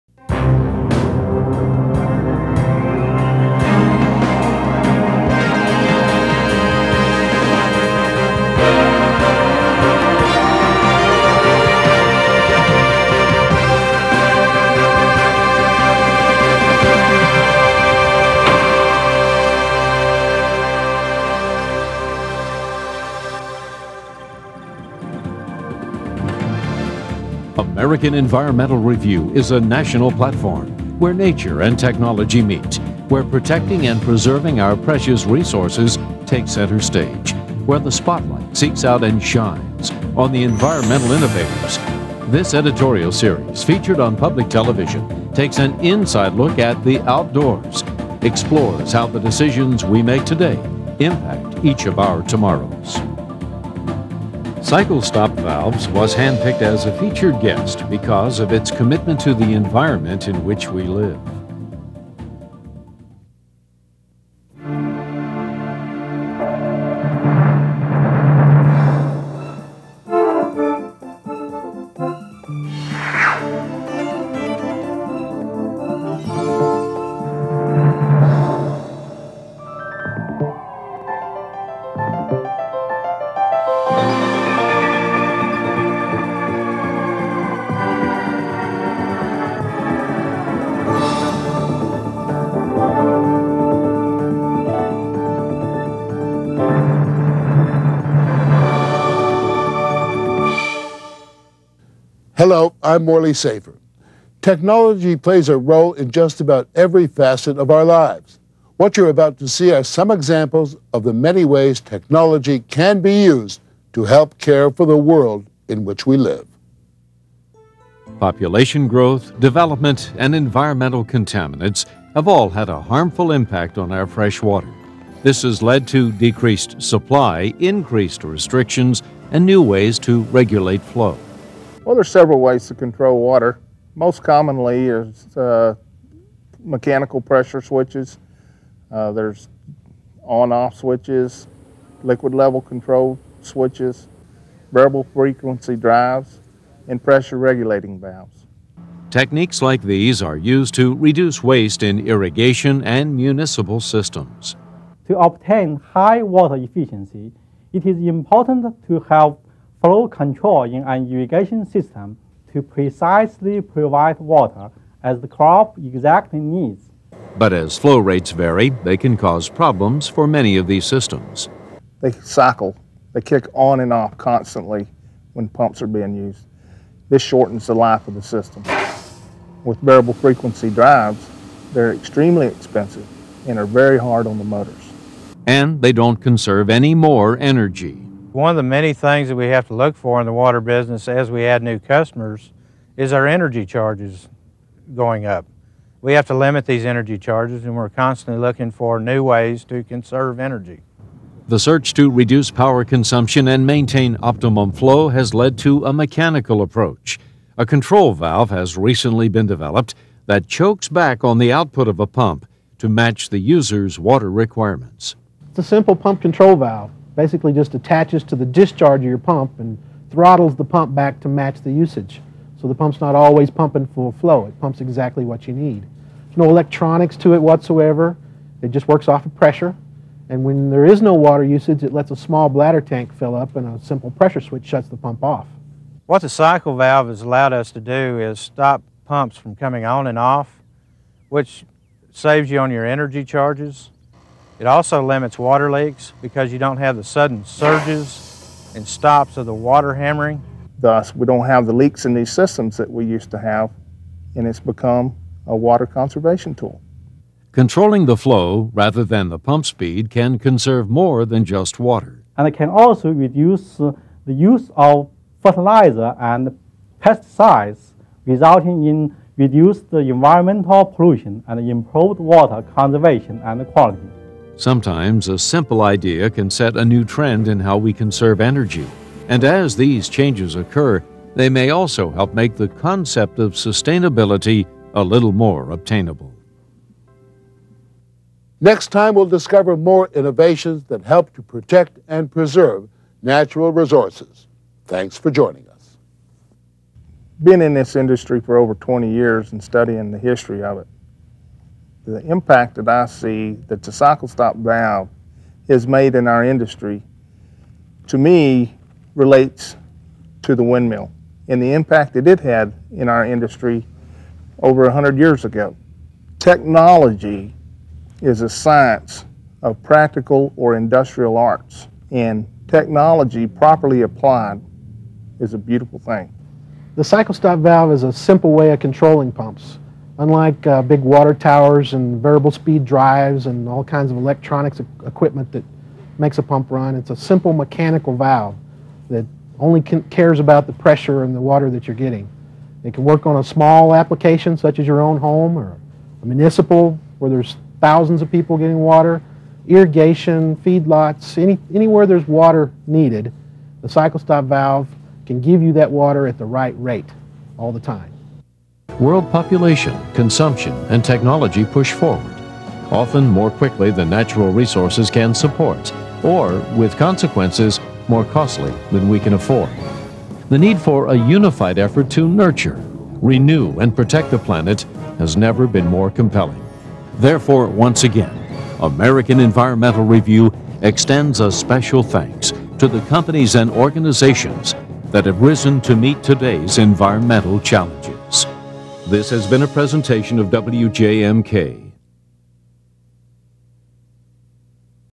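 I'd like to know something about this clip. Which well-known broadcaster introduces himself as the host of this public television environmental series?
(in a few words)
Morley Safer.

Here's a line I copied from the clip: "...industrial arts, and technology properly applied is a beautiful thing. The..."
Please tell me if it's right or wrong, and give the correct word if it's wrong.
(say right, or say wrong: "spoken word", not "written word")
right.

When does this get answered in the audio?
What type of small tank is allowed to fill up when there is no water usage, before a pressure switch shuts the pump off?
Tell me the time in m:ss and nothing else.
3:52.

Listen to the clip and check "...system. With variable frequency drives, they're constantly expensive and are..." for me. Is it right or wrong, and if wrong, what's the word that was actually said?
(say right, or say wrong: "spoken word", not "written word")
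wrong: "extremely", not "constantly".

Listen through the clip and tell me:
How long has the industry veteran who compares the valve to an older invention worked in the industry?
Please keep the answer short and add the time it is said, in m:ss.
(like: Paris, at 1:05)
over 20 years, at 4:58.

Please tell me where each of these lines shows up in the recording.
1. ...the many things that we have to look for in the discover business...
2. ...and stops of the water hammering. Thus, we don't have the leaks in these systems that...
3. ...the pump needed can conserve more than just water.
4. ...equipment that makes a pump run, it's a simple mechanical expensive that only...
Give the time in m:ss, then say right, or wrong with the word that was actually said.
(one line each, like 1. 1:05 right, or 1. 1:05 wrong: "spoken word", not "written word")
1. 3:08 wrong: "water", not "discover"
2. 4:08 right
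3. 4:19 wrong: "speed", not "needed"
4. 5:35 wrong: "valve", not "expensive".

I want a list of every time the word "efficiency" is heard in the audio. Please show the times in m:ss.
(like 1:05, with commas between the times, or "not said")
2:36.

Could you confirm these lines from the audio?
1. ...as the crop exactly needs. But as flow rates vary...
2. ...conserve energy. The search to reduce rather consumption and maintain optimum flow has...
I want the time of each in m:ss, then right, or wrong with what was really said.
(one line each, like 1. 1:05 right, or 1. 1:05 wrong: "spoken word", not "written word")
1. 2:45 right
2. 3:19 wrong: "power", not "rather".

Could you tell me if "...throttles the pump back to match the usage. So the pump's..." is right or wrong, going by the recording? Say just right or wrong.
right.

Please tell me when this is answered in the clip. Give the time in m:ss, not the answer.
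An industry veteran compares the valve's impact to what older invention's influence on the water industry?
5:10.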